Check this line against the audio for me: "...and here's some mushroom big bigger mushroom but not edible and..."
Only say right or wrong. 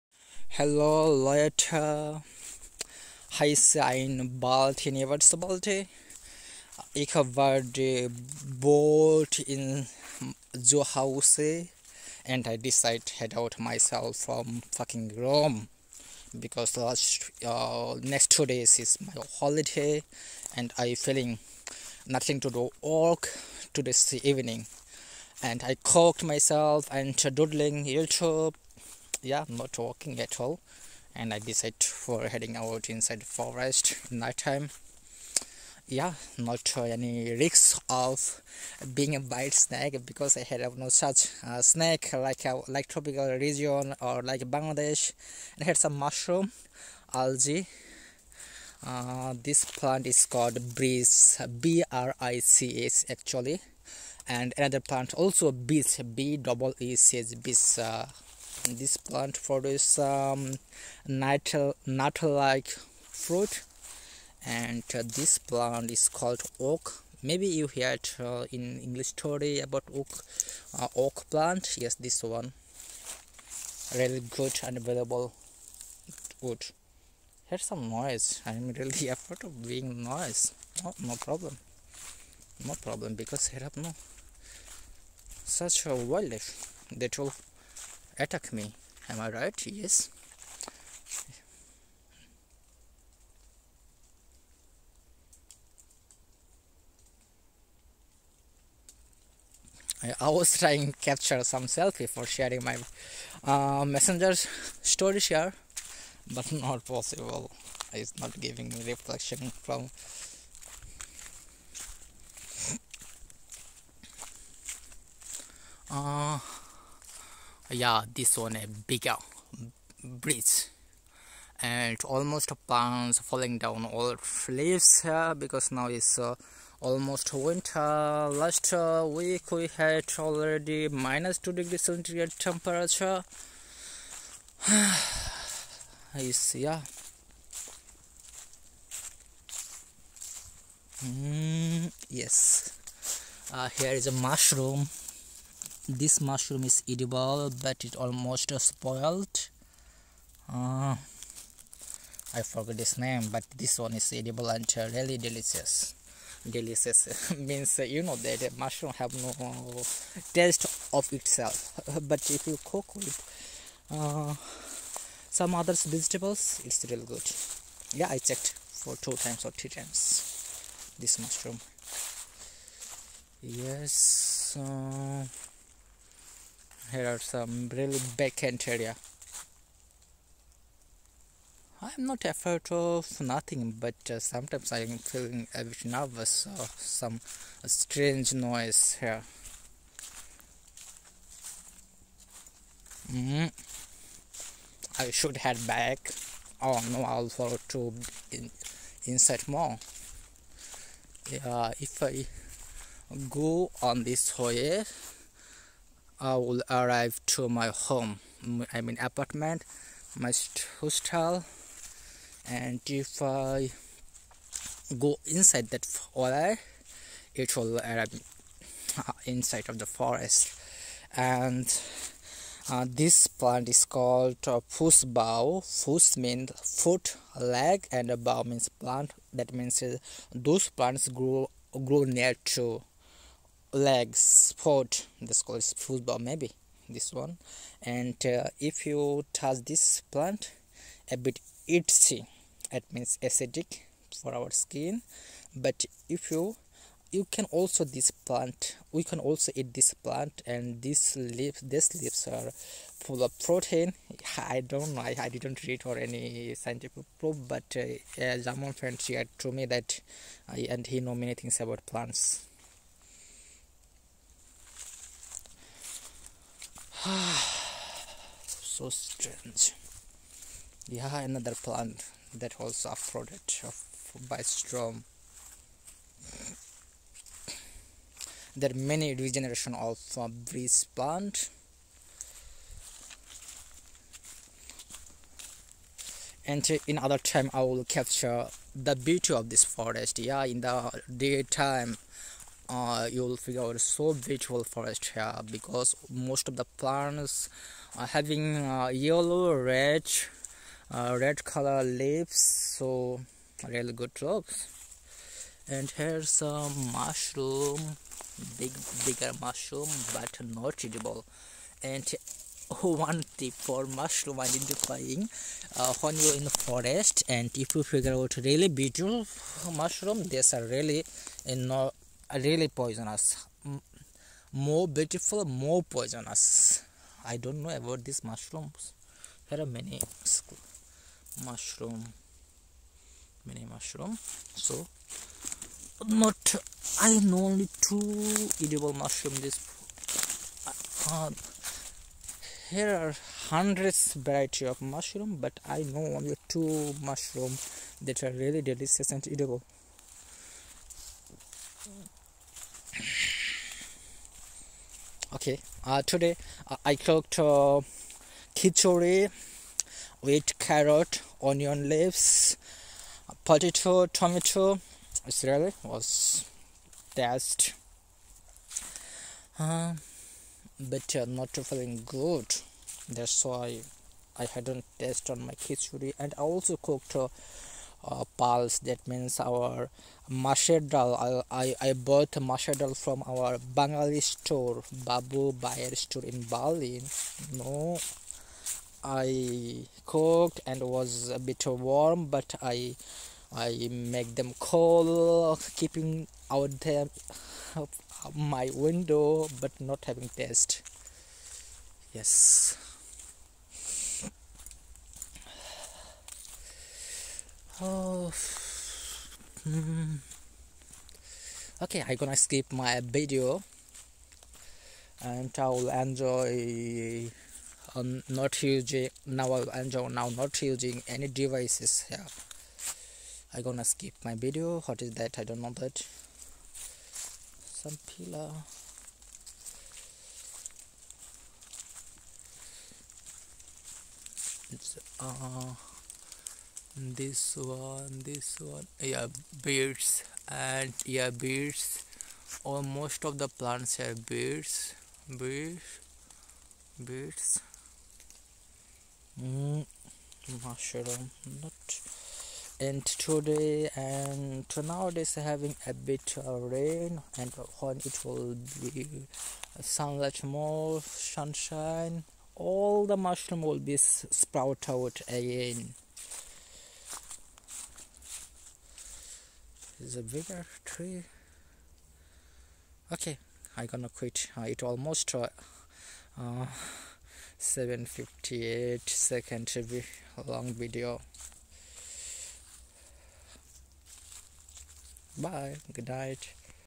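right.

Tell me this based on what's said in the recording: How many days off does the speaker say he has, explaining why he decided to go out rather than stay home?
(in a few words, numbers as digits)
2.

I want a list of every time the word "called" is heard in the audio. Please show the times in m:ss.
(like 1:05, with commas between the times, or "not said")
0:50, 1:06, 3:43, 3:55.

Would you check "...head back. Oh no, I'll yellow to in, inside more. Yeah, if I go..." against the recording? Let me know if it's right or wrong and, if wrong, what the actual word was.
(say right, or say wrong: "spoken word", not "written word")
wrong: "follow", not "yellow".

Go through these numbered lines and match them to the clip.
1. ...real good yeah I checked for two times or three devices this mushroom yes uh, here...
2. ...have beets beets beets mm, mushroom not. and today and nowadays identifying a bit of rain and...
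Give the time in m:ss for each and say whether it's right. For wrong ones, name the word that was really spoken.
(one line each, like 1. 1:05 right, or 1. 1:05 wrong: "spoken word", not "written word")
1. 2:46 wrong: "times", not "devices"
2. 7:23 wrong: "having", not "identifying".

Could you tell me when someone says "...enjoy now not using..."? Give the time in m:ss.
6:59.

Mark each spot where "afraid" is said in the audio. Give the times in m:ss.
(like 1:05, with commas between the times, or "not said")
1:19, 3:02.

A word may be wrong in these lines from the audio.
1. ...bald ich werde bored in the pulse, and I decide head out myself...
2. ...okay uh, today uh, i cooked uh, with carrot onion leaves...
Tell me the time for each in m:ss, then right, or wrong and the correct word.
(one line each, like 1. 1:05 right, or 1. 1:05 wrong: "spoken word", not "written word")
1. 0:05 wrong: "house", not "pulse"
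2. 5:55 right.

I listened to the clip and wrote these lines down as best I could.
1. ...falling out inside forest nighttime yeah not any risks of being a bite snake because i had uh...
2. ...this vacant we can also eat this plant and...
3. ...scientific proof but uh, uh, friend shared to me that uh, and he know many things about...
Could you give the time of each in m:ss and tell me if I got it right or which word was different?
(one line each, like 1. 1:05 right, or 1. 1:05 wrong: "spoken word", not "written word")
1. 0:32 wrong: "heading", not "falling"
2. 4:07 wrong: "plant", not "vacant"
3. 4:16 right.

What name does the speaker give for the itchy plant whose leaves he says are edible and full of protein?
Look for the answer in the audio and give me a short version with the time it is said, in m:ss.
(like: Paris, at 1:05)
Fusbao, at 3:44.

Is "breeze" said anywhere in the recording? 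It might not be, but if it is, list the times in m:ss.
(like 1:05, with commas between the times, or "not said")
0:50, 4:40.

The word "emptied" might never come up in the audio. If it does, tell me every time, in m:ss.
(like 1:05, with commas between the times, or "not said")
not said.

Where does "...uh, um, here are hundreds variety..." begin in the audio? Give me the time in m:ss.
5:40.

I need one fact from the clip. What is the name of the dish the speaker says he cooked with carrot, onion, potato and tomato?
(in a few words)
Khichdi.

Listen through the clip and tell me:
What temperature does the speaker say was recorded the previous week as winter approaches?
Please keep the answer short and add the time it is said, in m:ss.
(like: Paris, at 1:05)
minus 2 degrees centigrade, at 2:10.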